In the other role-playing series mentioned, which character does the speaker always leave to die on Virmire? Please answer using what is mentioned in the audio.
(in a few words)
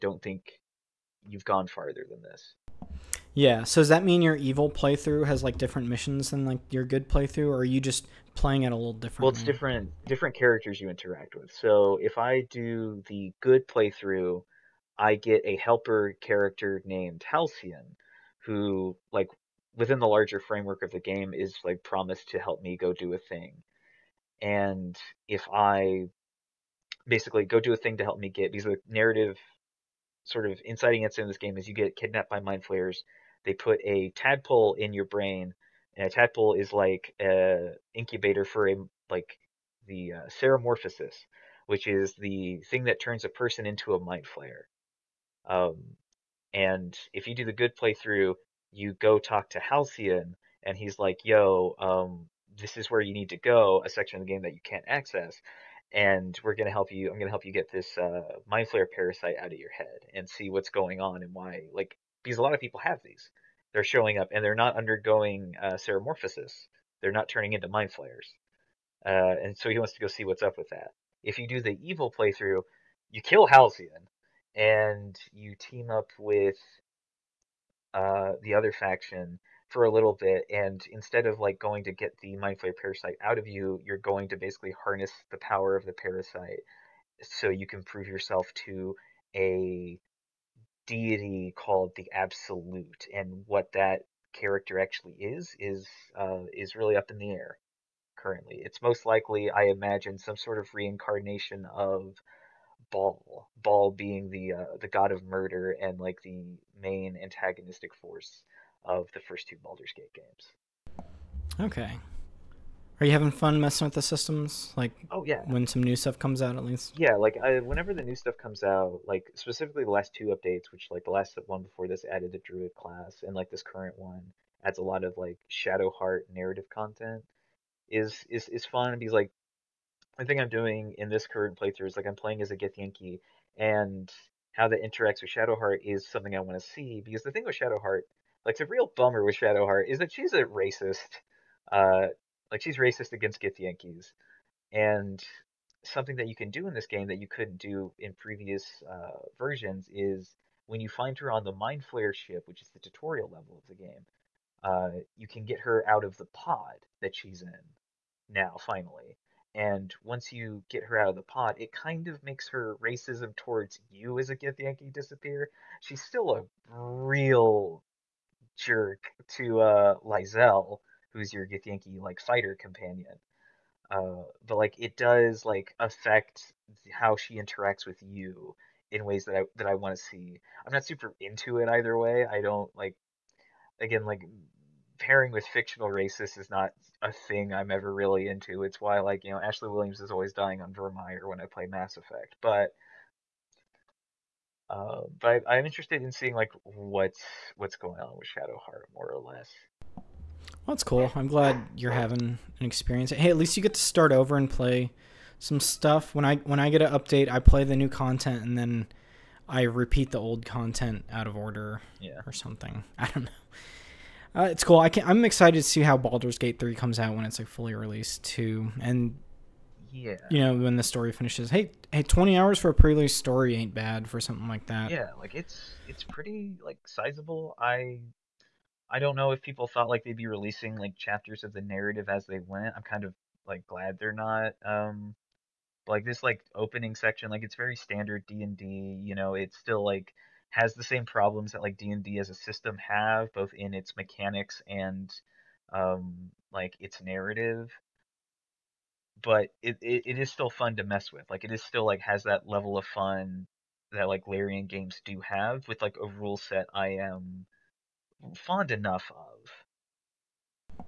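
Ashley Williams.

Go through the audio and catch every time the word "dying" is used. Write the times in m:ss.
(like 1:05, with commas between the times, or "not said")
3:10.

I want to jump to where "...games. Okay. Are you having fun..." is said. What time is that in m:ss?
1:50.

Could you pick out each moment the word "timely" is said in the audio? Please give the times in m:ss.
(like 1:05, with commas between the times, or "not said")
not said.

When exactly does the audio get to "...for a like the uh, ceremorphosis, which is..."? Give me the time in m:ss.
0:38.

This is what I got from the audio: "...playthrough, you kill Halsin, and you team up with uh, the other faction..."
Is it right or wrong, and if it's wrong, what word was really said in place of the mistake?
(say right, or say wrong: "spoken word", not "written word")
right.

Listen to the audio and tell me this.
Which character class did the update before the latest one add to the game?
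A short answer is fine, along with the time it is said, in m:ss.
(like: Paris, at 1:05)
Druid, at 2:02.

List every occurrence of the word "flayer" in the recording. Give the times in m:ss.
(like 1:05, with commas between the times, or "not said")
0:32, 0:44, 0:58, 1:22, 2:31.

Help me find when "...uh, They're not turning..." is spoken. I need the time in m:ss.
1:05.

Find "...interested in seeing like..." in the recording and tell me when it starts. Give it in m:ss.
3:15.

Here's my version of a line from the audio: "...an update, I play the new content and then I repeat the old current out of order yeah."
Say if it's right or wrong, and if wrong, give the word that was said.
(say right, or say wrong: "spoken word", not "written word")
wrong: "content", not "current".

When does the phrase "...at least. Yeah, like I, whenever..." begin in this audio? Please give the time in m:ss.
1:56.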